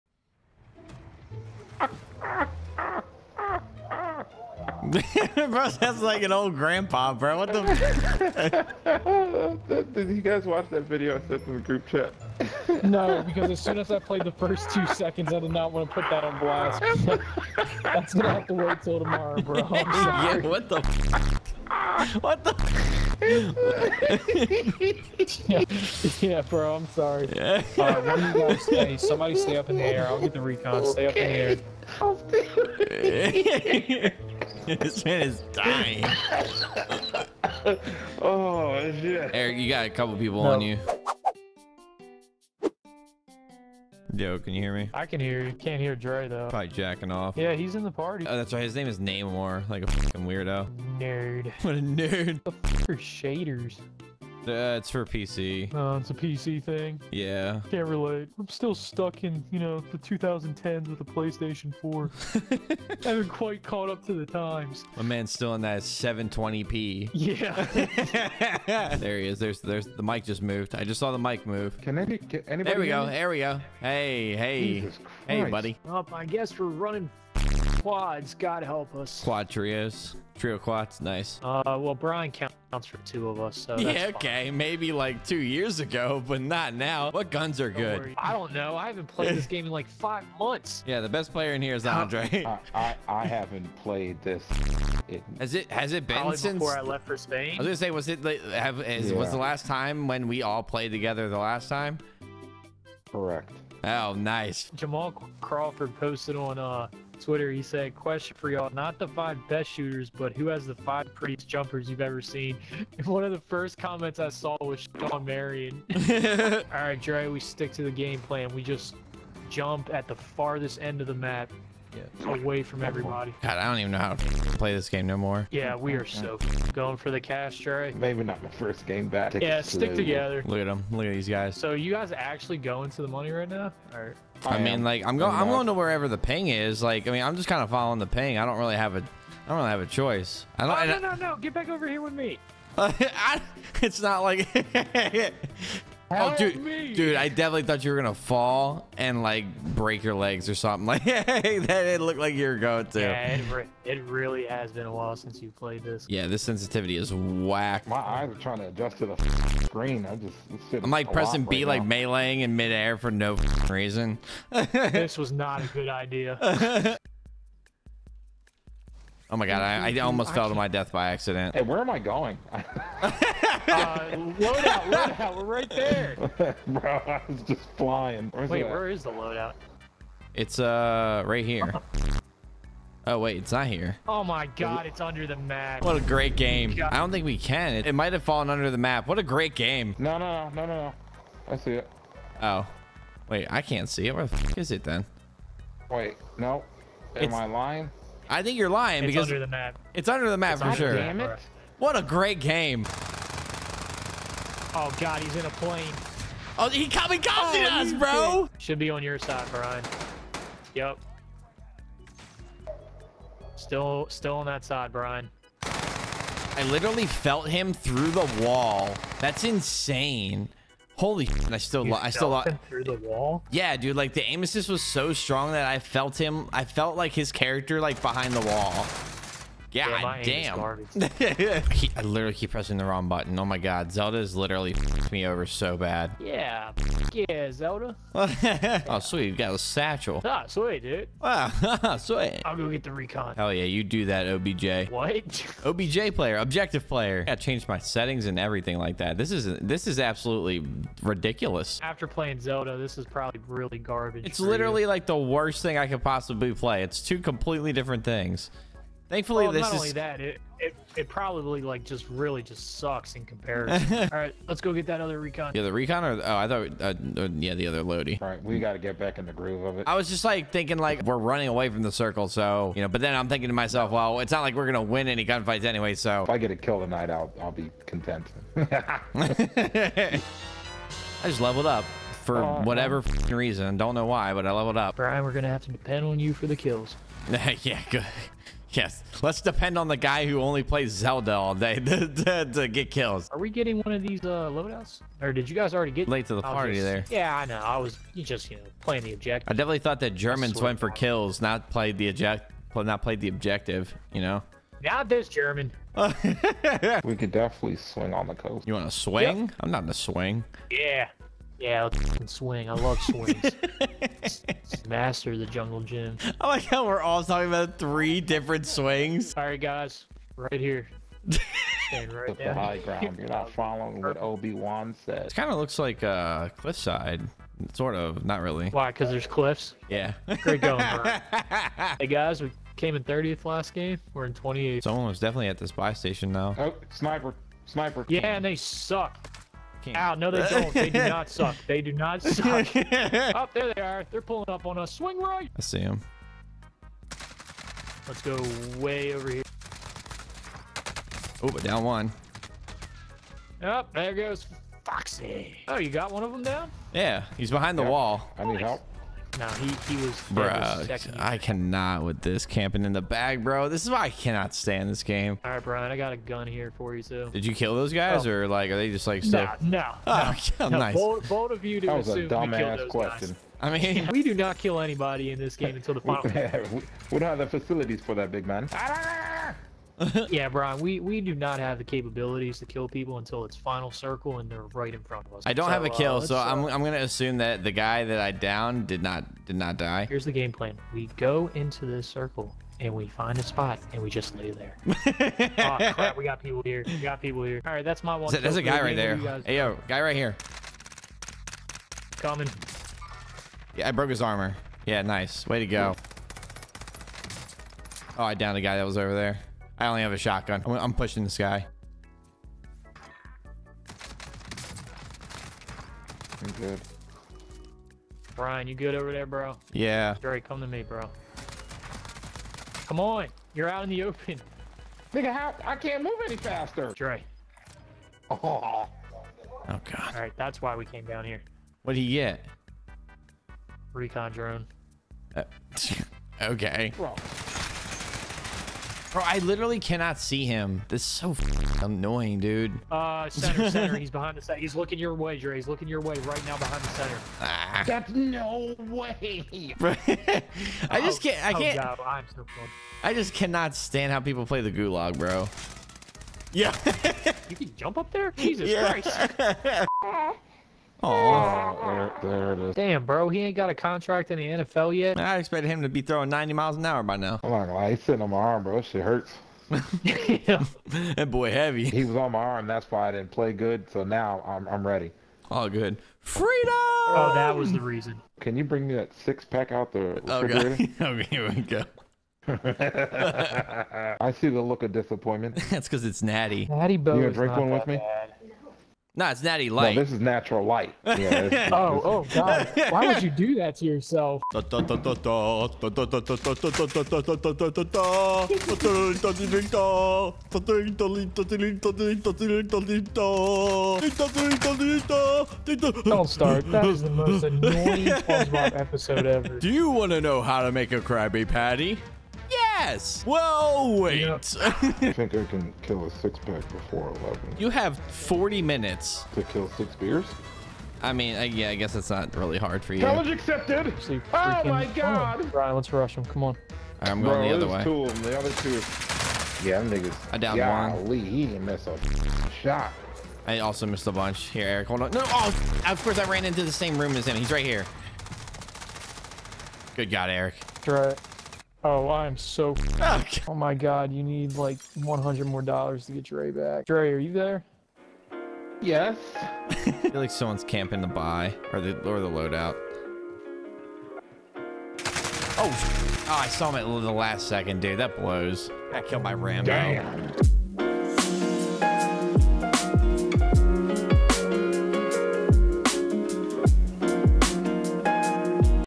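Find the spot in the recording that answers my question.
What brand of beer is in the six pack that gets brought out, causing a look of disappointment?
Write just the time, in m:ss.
8:10.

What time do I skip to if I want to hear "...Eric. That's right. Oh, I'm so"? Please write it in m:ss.
9:00.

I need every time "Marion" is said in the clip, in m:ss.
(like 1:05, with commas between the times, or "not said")
1:55.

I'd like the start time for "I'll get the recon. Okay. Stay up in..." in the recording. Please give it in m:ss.
0:30.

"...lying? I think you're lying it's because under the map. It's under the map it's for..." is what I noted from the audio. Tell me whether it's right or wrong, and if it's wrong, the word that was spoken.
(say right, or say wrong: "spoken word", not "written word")
right.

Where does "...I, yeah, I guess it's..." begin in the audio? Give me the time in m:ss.
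8:41.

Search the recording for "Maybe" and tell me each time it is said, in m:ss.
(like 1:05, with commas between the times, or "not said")
1:24, 2:07.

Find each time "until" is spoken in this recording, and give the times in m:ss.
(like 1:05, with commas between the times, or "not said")
6:15, 6:23.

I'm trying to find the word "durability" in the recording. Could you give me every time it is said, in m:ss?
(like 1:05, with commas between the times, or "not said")
not said.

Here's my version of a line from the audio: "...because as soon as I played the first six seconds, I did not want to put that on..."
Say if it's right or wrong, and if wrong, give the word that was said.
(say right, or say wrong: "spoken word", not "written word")
wrong: "two", not "six".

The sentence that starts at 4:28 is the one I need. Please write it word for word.
All right, we got to get back in the groove of it.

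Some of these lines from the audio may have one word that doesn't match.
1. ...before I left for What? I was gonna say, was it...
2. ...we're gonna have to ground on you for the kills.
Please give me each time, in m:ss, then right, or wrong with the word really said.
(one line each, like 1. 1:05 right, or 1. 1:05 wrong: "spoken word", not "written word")
1. 1:36 wrong: "Spain", not "What"
2. 4:45 wrong: "depend", not "ground".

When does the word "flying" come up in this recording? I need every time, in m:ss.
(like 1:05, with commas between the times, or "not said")
2:57.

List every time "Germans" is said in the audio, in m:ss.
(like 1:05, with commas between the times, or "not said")
5:00, 5:05.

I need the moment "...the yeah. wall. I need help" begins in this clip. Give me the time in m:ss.
5:57.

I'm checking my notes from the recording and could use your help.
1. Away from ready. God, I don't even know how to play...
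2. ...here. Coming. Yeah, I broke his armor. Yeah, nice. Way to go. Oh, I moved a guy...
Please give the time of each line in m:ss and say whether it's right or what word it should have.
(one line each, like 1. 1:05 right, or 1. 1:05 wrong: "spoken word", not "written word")
1. 2:02 wrong: "everybody", not "ready"
2. 6:40 wrong: "downed", not "moved".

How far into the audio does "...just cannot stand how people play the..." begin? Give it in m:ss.
7:33.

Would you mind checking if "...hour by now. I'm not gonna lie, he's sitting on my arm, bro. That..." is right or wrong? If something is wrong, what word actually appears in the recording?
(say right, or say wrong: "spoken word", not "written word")
right.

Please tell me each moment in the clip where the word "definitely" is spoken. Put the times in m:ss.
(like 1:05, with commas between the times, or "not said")
2:27, 4:59, 5:07, 5:35.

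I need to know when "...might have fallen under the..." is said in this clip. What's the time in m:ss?
3:07.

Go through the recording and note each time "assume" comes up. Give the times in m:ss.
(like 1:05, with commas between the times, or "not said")
6:26.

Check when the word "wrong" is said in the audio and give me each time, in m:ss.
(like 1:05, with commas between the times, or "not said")
3:52.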